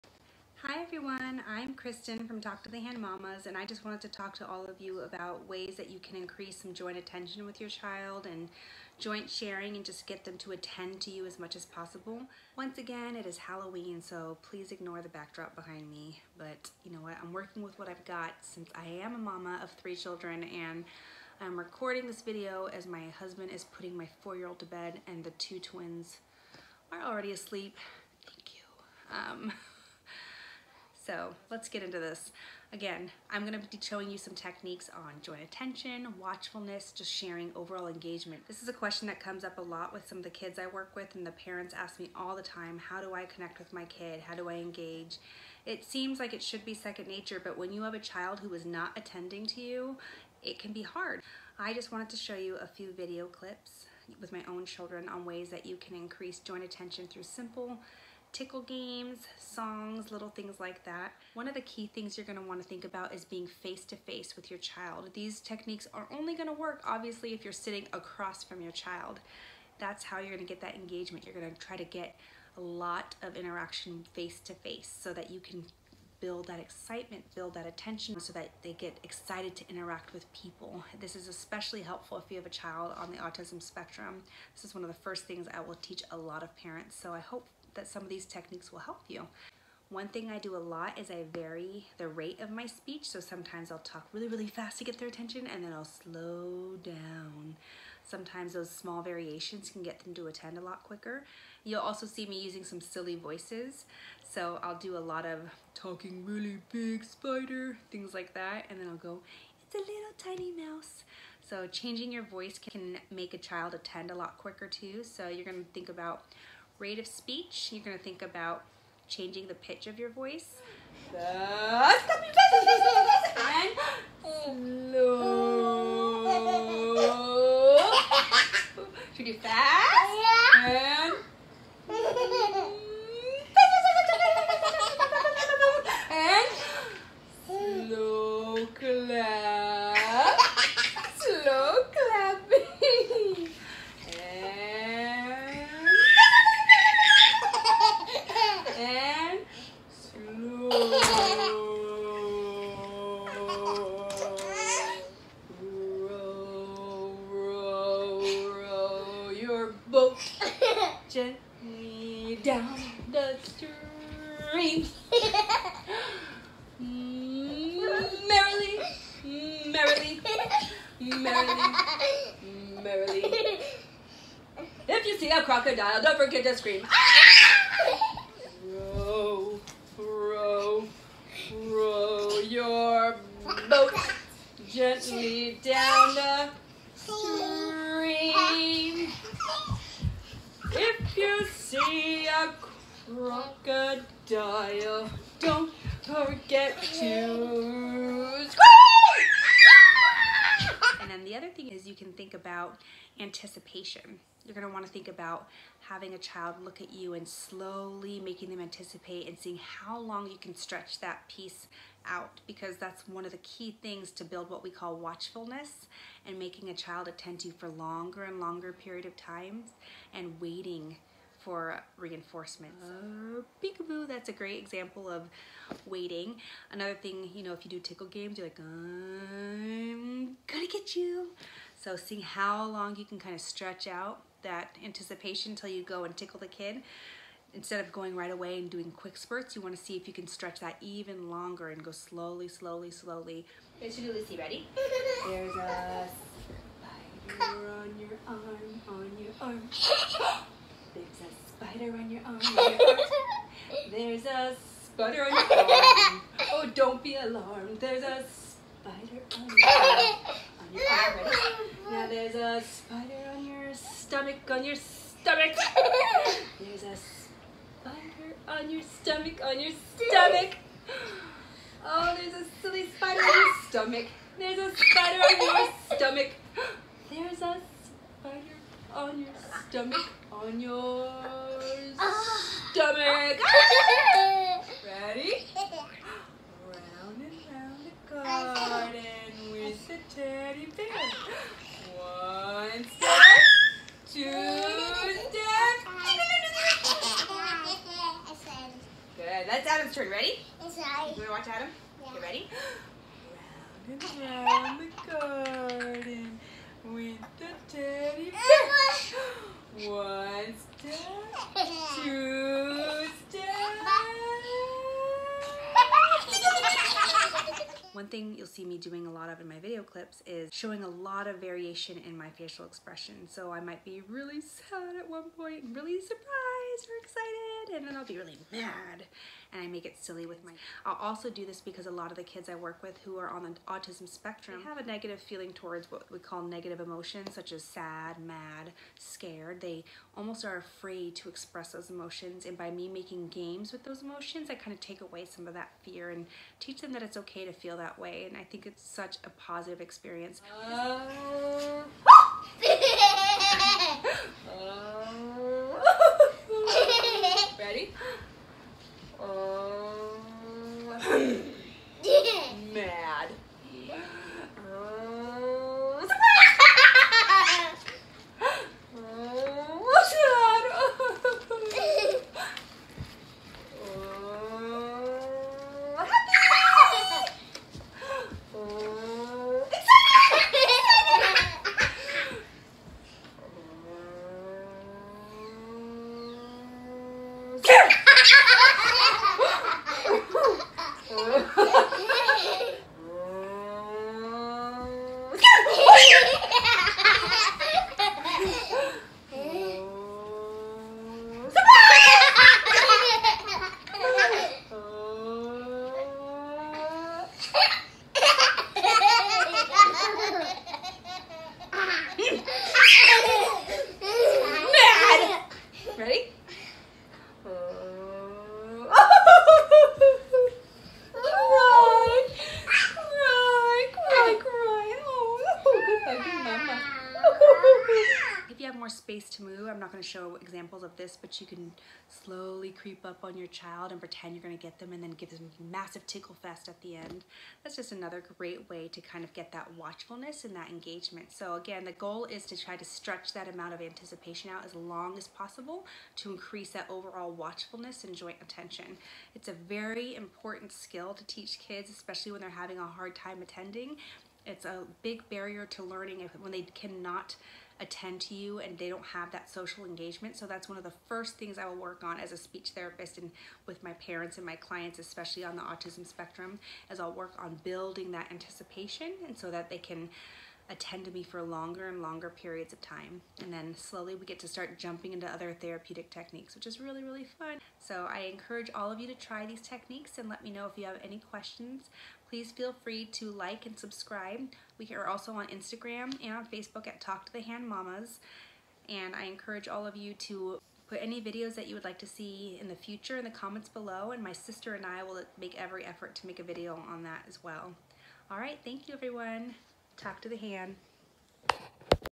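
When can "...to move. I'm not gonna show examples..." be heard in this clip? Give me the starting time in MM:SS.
07:09.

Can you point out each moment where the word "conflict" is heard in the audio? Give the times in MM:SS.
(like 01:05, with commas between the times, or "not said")
not said.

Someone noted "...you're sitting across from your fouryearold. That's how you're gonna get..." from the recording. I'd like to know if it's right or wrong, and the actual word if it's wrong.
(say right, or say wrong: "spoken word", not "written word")
wrong: "child", not "fouryearold".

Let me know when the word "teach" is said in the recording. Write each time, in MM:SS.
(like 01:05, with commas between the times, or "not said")
01:25, 05:46, 07:31.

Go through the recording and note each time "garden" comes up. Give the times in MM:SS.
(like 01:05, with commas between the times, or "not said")
04:48, 05:05.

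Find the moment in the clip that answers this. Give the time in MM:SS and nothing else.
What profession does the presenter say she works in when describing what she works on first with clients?
07:42.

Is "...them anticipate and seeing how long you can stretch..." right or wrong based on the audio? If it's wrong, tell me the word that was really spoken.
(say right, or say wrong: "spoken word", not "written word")
right.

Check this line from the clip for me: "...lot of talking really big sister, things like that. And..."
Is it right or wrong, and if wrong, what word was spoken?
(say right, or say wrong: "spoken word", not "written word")
wrong: "spider", not "sister".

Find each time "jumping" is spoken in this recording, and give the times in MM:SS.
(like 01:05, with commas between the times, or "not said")
07:54.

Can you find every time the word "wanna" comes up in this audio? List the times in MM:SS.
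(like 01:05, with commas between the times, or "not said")
03:24.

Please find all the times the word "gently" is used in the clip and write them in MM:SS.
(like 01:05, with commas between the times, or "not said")
02:41, 03:04.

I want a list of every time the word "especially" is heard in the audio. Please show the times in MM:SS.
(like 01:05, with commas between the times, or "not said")
01:21, 07:31, 07:44.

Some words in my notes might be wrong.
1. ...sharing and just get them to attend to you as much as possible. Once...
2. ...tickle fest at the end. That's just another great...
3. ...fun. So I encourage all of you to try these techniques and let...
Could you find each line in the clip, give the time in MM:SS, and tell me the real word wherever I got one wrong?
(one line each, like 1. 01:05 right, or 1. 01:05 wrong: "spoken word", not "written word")
1. 00:09 right
2. 07:16 right
3. 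07:57 right.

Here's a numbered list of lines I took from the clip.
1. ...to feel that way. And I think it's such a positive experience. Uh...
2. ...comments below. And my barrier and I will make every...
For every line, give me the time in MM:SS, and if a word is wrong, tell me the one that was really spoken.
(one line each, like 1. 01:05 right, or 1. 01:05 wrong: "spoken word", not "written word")
1. 05:47 right
2. 08:13 wrong: "sister", not "barrier".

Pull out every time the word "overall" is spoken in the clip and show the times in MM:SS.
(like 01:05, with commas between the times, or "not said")
00:37, 07:26.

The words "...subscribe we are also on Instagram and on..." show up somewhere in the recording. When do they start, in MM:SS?
08:03.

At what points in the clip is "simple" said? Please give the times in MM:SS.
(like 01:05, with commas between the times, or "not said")
00:57.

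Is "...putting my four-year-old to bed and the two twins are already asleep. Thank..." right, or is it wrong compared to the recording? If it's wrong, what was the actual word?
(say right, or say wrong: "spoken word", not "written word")
right.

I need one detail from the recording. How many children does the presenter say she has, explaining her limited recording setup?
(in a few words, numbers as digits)
3.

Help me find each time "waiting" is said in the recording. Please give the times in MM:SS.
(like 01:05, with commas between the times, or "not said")
03:40, 03:45.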